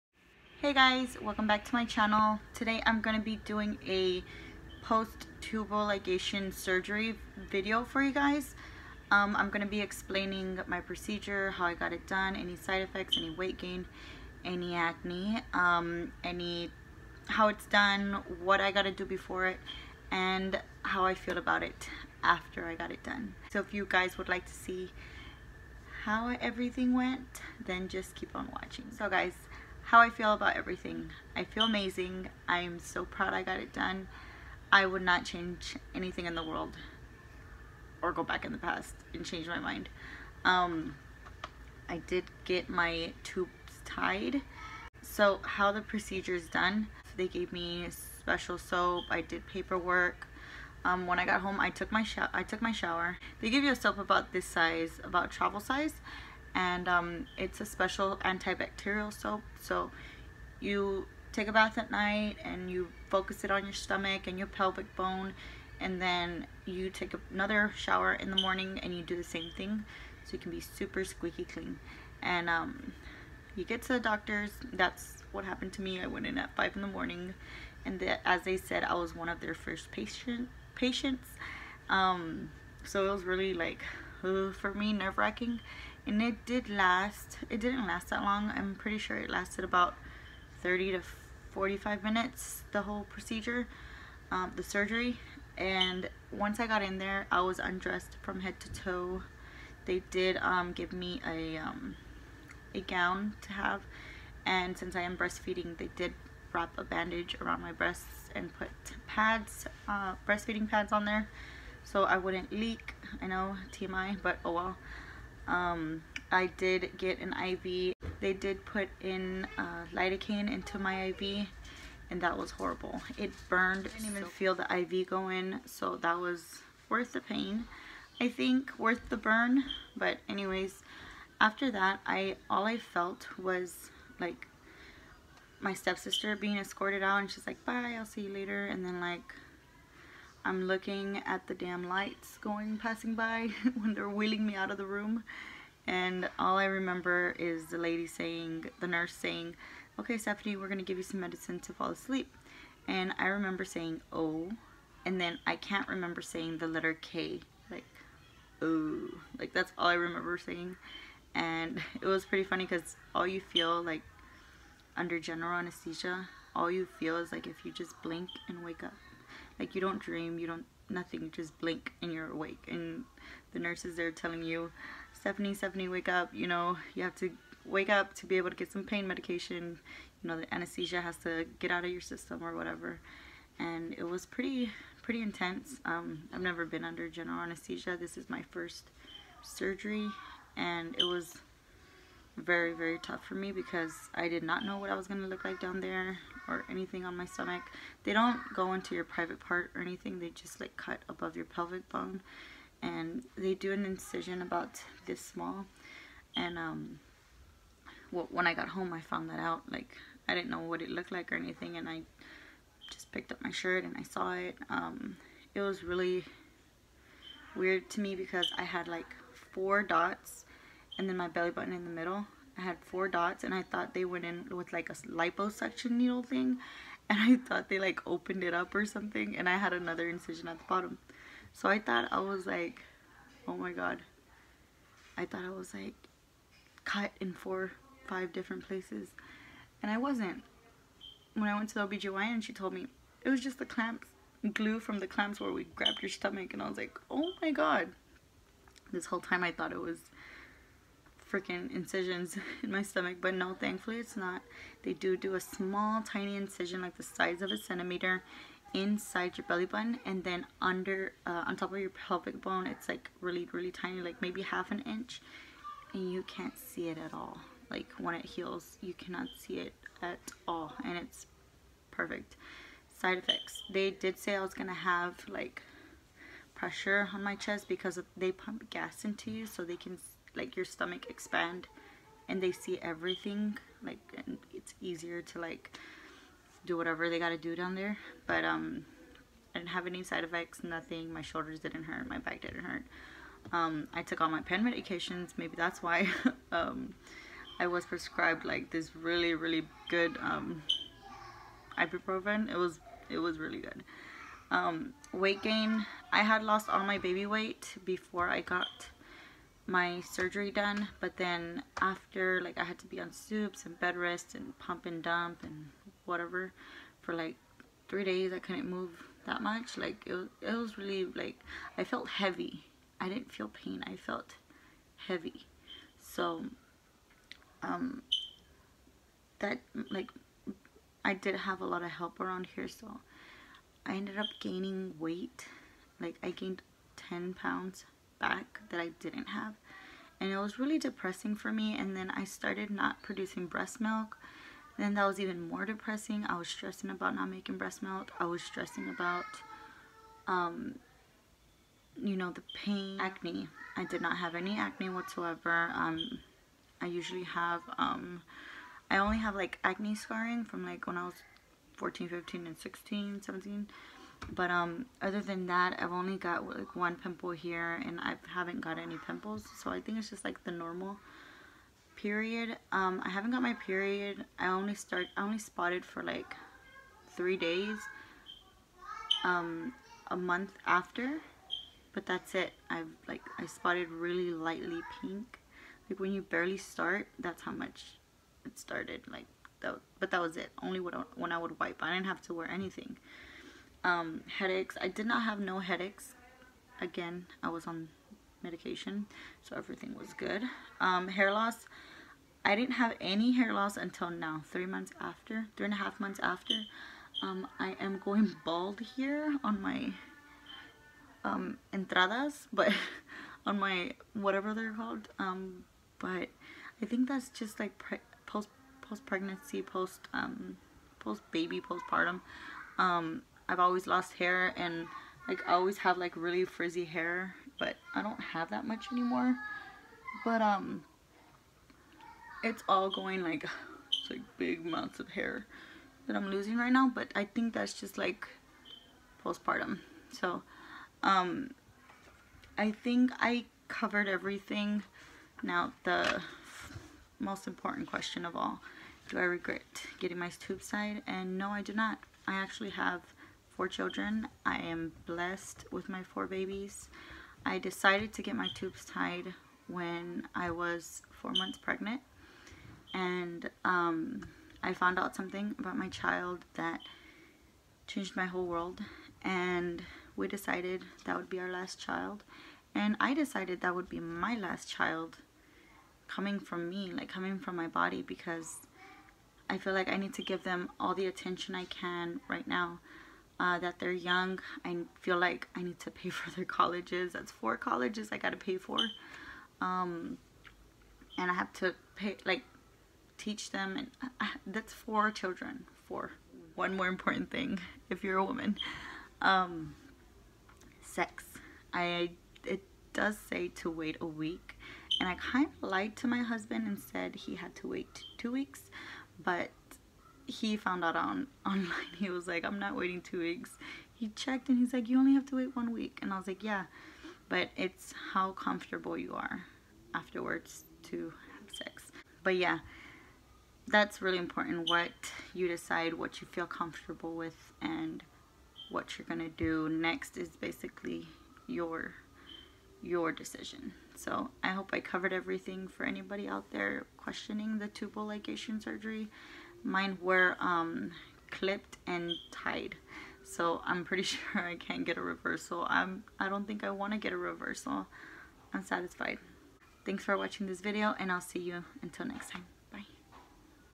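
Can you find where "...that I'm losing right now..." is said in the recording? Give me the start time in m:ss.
7:16.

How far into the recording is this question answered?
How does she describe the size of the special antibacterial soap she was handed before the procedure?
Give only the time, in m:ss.
0:55.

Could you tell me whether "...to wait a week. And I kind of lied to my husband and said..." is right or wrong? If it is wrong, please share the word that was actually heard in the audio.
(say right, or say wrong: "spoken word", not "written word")
right.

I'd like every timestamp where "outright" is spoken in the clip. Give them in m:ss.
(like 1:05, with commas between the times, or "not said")
not said.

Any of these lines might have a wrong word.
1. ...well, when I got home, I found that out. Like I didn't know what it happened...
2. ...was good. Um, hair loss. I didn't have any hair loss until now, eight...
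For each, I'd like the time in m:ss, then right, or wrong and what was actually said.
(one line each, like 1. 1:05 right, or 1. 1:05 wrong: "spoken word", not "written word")
1. 3:28 wrong: "looked", not "happened"
2. 6:39 wrong: "three", not "eight".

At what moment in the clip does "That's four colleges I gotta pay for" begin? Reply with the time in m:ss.
8:07.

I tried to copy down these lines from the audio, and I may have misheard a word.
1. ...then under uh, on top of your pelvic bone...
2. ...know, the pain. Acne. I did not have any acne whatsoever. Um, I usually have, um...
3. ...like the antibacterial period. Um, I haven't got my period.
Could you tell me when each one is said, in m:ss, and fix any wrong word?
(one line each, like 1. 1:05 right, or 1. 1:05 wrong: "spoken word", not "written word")
1. 4:20 right
2. 5:52 right
3. 6:10 wrong: "normal", not "antibacterial".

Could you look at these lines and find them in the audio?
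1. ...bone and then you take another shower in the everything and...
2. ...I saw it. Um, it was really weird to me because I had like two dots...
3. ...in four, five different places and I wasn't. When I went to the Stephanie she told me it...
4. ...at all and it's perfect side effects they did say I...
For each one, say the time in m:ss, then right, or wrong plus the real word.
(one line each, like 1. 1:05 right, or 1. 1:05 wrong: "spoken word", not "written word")
1. 1:04 wrong: "morning", not "everything"
2. 3:33 wrong: "four", not "two"
3. 3:57 wrong: "OBGYN", not "Stephanie"
4. 4:30 right.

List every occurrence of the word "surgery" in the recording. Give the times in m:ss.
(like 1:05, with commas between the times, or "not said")
0:06, 1:34, 3:09, 5:10, 8:58.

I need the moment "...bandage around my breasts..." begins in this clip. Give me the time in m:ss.
1:46.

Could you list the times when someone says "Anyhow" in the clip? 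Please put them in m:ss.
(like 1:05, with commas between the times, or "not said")
not said.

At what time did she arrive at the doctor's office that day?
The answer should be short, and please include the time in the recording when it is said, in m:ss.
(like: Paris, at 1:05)
5 a.m., at 1:16.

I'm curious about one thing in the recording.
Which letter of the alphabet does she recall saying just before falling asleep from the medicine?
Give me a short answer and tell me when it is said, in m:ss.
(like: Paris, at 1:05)
K, at 2:36.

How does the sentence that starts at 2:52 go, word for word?
And the nurses are telling you, Stephanie, Stephanie, wake up.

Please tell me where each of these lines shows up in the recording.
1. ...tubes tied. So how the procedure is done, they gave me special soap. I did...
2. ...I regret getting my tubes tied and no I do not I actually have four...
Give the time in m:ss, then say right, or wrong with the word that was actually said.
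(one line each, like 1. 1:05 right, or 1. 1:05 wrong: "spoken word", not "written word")
1. 0:43 right
2. 7:29 right.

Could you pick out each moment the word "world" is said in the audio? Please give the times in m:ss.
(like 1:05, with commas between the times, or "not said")
0:36, 7:48.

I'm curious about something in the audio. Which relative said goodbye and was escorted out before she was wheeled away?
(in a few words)
Stepsister.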